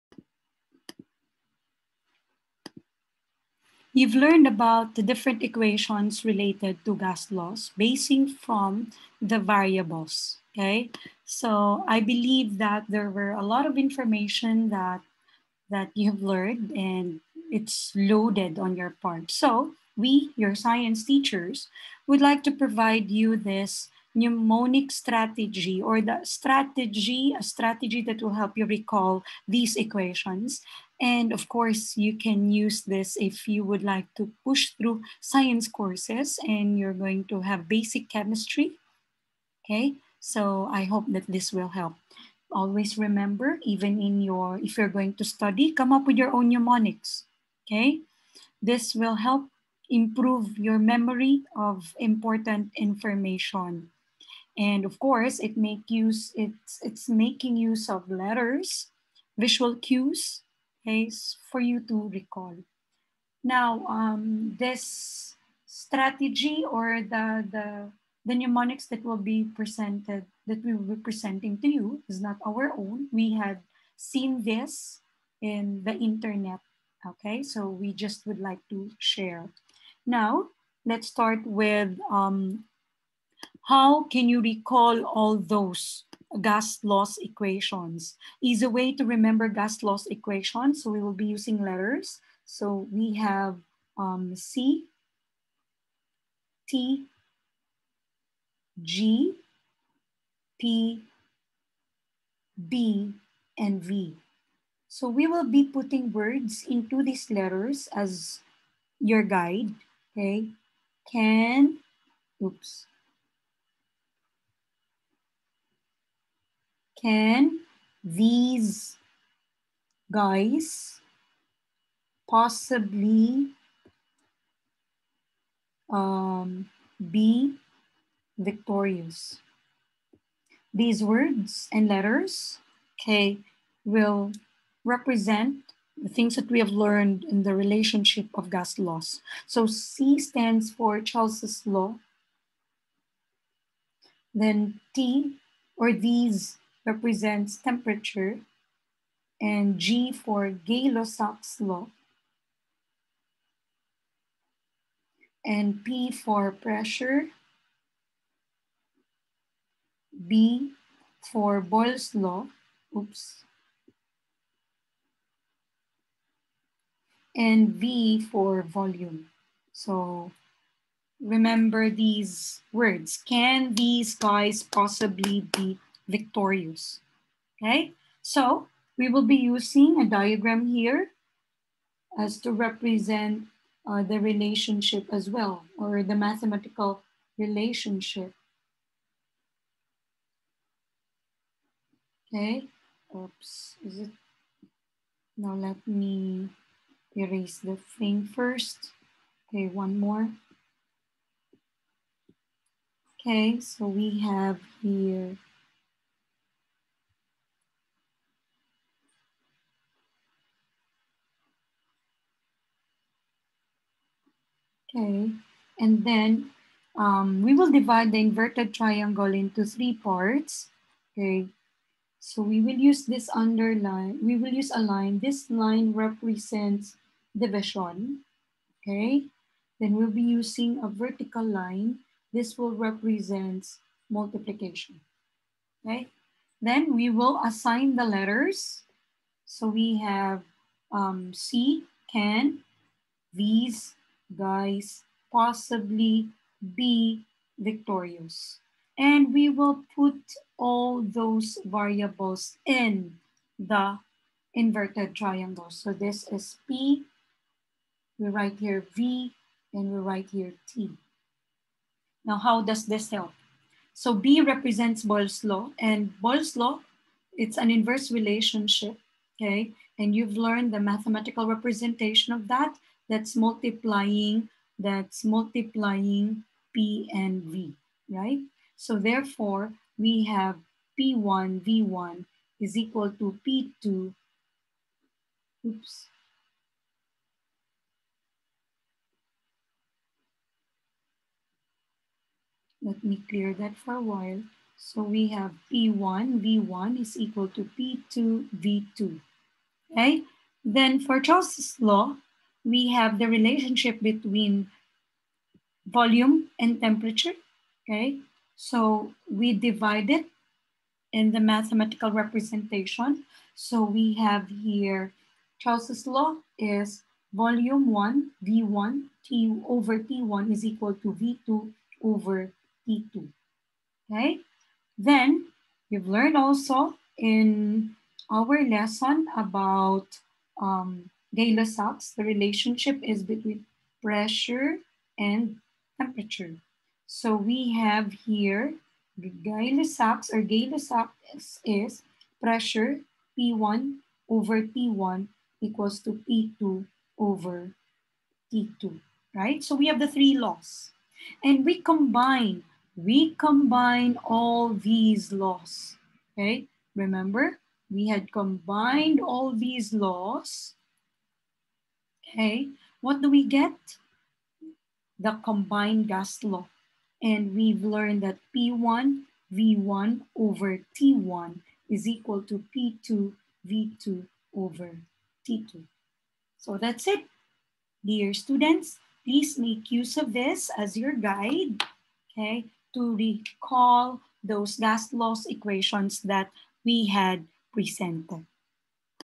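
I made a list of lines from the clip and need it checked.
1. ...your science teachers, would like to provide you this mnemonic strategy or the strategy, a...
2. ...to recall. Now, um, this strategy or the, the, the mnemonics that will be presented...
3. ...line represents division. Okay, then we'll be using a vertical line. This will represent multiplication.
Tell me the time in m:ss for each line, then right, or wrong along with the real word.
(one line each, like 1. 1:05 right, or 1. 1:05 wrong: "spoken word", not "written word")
1. 0:20 right
2. 1:01 right
3. 3:45 right.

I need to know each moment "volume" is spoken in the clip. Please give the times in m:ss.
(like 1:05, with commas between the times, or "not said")
2:48, 5:05, 5:17.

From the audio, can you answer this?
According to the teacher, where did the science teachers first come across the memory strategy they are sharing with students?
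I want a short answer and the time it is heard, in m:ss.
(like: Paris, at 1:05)
the internet, at 1:15.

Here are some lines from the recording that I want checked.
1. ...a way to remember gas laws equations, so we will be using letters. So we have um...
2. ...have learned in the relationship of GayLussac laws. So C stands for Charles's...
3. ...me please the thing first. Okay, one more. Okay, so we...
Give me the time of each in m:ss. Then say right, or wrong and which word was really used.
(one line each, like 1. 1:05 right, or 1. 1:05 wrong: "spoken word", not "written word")
1. 1:28 right
2. 2:16 wrong: "Gas", not "GayLussac"
3. 3:15 wrong: "erase", not "please".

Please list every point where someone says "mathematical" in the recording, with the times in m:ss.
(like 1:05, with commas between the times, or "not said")
3:06, 4:30, 5:11.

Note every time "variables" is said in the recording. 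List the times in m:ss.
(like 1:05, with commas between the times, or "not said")
0:09, 4:11.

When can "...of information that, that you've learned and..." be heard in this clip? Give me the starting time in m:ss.
0:13.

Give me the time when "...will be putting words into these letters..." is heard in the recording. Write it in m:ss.
1:45.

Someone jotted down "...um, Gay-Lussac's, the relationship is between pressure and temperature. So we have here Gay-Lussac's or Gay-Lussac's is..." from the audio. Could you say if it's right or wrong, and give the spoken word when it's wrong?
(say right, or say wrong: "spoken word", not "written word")
right.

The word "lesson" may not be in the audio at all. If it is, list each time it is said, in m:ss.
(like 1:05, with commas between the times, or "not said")
5:28.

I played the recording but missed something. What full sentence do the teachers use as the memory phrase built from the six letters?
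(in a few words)
Can these guys possibly be victorious.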